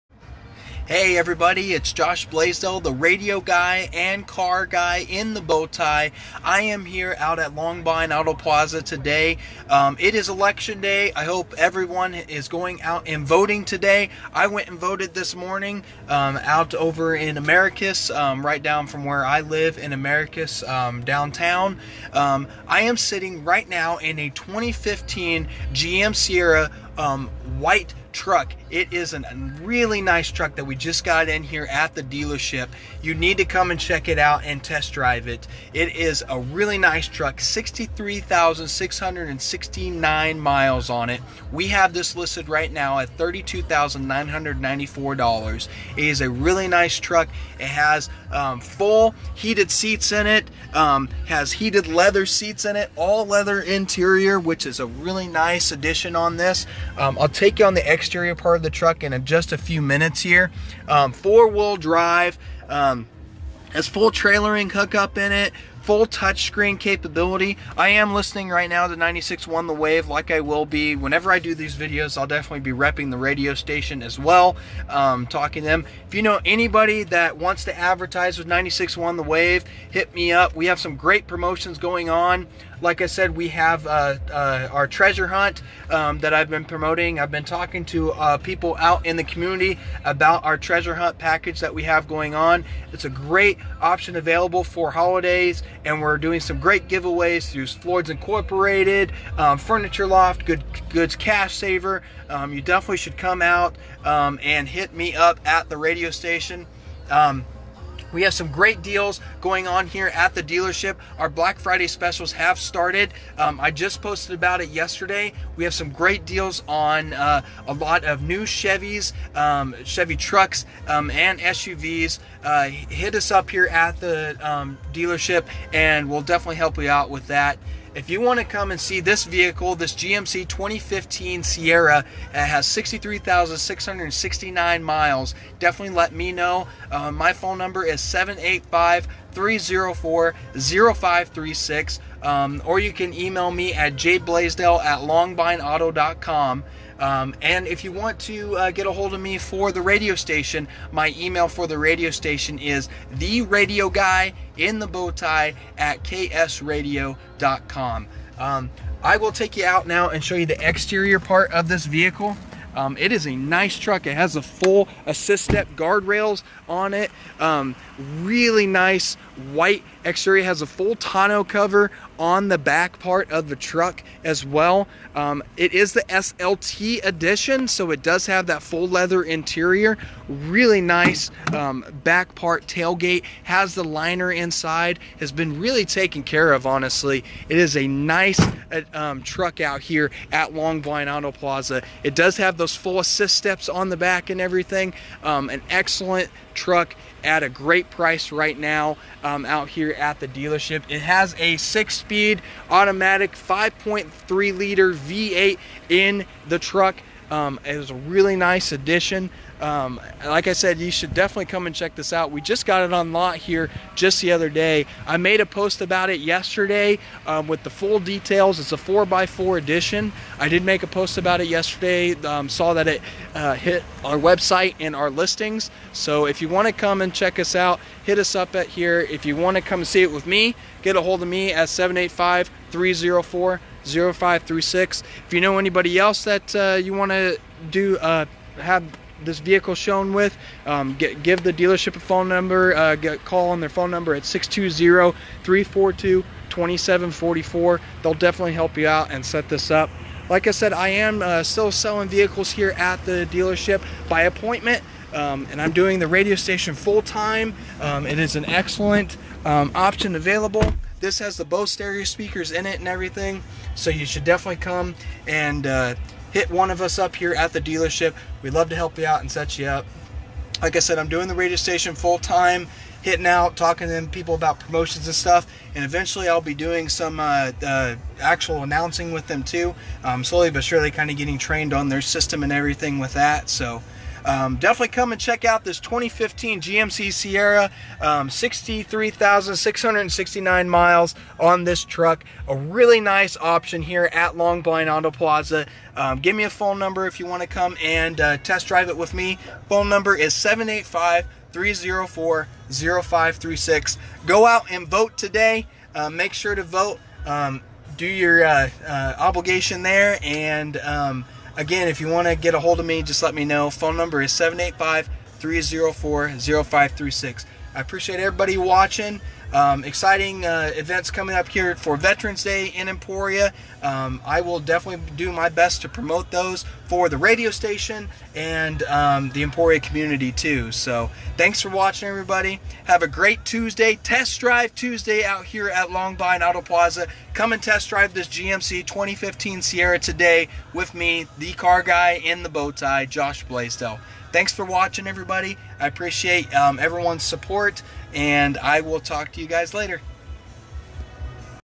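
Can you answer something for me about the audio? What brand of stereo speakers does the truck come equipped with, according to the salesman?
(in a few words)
Bose.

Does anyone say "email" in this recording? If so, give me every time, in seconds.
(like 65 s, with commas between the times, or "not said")
143 s, 151 s.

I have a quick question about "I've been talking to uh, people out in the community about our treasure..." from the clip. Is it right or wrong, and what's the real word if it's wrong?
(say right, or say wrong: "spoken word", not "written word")
right.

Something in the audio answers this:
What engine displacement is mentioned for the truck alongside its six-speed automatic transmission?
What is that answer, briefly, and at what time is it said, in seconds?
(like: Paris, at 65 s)
5.3 liter, at 203 s.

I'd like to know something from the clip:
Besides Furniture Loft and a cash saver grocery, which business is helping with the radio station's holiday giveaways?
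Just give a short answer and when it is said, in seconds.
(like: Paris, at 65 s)
Floyd's Incorporated, at 97 s.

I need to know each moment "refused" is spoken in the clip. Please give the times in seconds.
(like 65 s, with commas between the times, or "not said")
not said.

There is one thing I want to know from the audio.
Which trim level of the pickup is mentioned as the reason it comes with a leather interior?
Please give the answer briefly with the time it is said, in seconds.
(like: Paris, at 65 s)
SLT, at 176 s.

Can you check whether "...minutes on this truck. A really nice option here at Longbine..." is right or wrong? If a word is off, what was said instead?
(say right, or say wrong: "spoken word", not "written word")
wrong: "miles", not "minutes".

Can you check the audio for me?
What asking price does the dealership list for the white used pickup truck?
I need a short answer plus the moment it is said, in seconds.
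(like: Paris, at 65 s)
$32,994, at 43 s.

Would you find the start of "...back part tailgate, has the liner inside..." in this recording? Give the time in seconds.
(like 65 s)
182 s.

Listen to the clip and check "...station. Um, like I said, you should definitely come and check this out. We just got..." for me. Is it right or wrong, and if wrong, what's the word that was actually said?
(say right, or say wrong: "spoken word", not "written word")
wrong: "addition", not "station".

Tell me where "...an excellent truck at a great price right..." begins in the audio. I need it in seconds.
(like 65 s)
195 s.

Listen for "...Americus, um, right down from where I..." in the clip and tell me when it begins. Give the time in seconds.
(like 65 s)
17 s.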